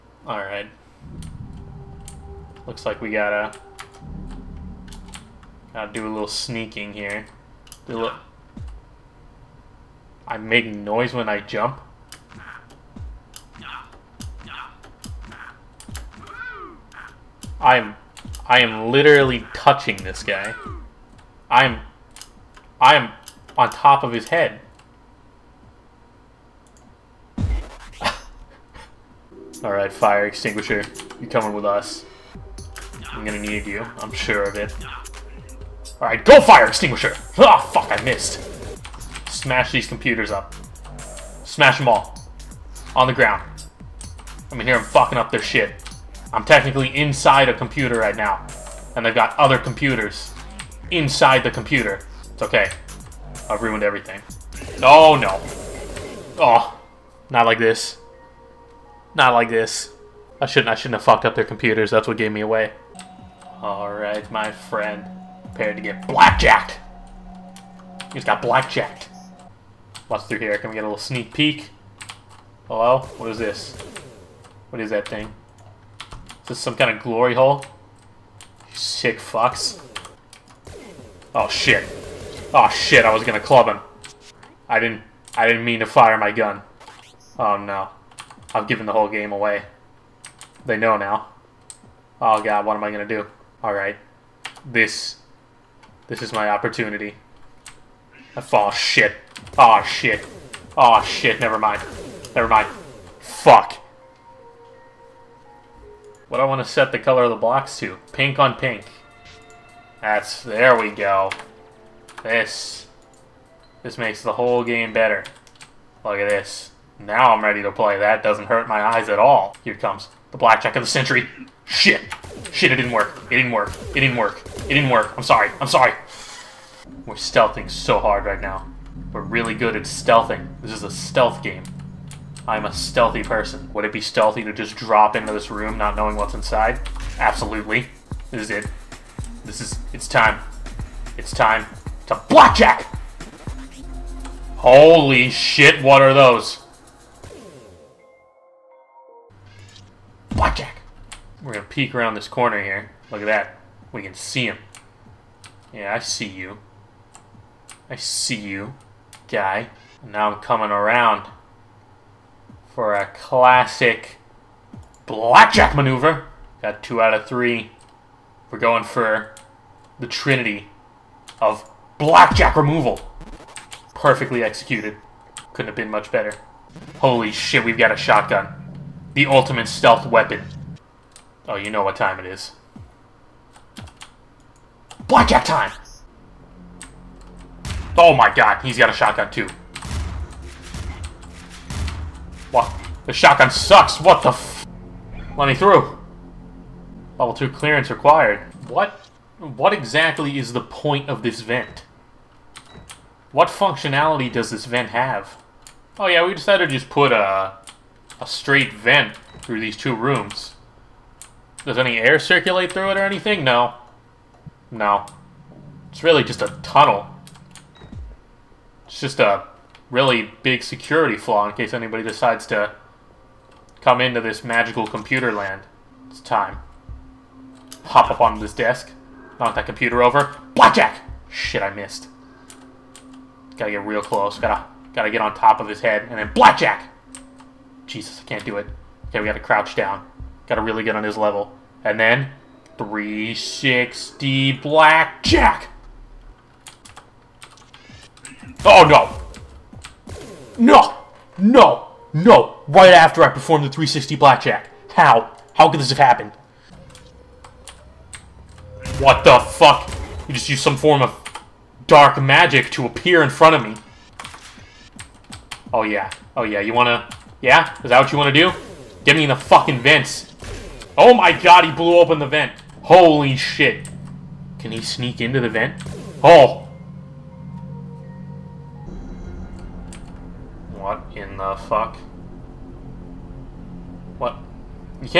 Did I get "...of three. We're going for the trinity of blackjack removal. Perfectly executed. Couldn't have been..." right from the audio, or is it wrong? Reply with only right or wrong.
right.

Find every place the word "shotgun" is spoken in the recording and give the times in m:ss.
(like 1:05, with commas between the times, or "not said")
2:57, 3:08, 3:13.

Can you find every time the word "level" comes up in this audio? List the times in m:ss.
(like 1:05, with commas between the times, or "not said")
3:17, 4:01.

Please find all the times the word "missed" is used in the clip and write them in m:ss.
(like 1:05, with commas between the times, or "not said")
0:38, 3:51.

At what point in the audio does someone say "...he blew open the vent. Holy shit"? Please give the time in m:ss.
4:31.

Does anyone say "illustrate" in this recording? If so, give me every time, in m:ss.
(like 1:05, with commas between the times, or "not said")
not said.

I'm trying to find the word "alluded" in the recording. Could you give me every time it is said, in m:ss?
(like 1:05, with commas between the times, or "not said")
not said.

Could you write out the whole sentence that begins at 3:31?
Does any air circulate through it or anything?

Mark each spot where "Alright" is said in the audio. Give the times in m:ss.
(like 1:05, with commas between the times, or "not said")
0:00, 0:29, 0:36, 1:03, 1:33.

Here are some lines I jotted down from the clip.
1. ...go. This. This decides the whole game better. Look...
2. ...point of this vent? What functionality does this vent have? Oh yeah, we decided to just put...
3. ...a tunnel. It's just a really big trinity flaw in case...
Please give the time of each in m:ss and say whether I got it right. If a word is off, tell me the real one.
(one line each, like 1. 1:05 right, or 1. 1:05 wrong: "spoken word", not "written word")
1. 1:50 wrong: "makes", not "decides"
2. 3:20 right
3. 3:36 wrong: "security", not "trinity".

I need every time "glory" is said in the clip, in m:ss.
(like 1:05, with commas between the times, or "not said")
1:17.